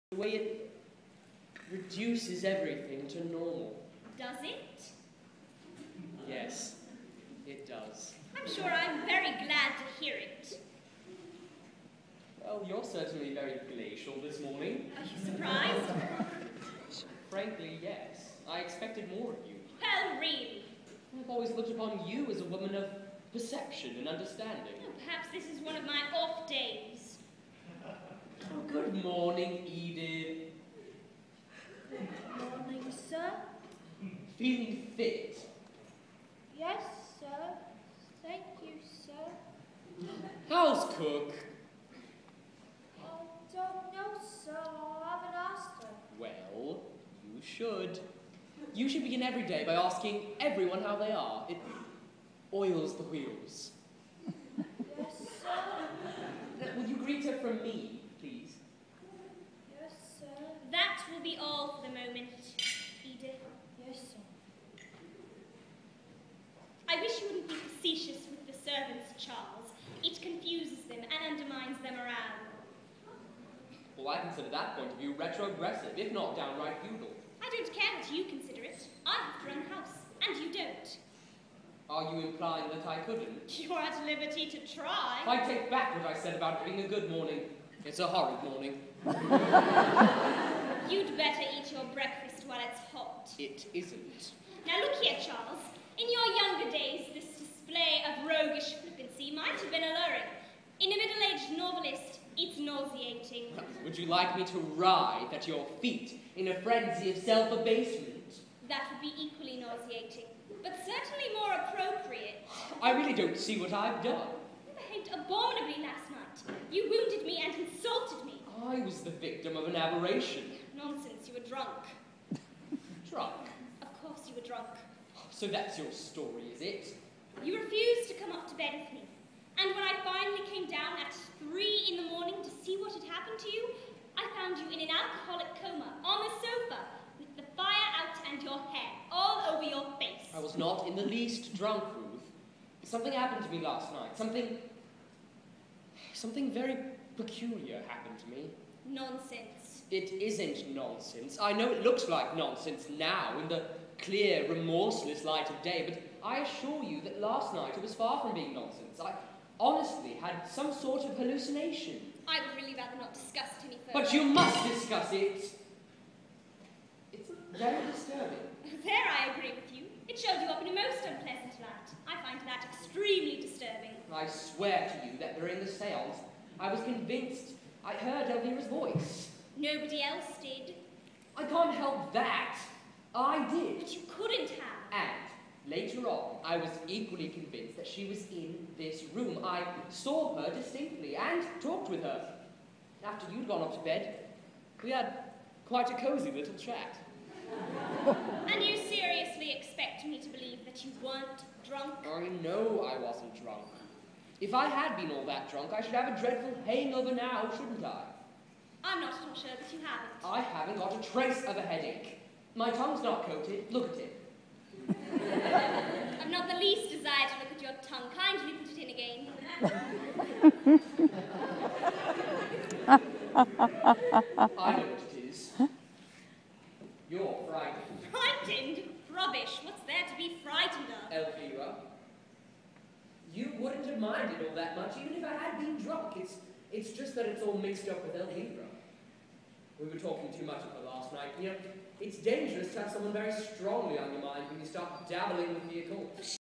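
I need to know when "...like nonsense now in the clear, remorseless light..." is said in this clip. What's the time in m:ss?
2:32.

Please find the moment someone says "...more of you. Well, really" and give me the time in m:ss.
0:19.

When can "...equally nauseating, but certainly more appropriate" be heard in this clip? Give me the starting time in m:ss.
1:49.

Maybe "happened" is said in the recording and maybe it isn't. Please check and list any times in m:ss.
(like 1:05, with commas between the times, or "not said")
2:13, 2:23, 2:27.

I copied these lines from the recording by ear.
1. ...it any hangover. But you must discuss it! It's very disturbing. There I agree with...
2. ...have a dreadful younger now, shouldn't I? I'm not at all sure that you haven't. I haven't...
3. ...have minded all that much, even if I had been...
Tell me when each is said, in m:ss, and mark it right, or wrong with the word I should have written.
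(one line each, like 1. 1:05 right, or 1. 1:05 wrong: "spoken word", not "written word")
1. 2:43 wrong: "further", not "hangover"
2. 3:25 wrong: "hangover", not "younger"
3. 3:53 right.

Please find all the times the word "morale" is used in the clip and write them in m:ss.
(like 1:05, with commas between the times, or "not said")
1:11.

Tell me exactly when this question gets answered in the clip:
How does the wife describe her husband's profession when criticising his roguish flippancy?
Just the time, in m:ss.
1:40.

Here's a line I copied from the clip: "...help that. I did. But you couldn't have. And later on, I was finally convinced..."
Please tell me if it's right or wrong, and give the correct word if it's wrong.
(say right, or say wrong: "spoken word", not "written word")
wrong: "equally", not "finally".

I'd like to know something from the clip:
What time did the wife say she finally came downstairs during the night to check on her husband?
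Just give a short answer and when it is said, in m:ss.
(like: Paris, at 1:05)
3 in the morning, at 2:11.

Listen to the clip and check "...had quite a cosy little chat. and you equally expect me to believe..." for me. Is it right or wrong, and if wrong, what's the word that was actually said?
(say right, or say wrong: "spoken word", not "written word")
wrong: "seriously", not "equally".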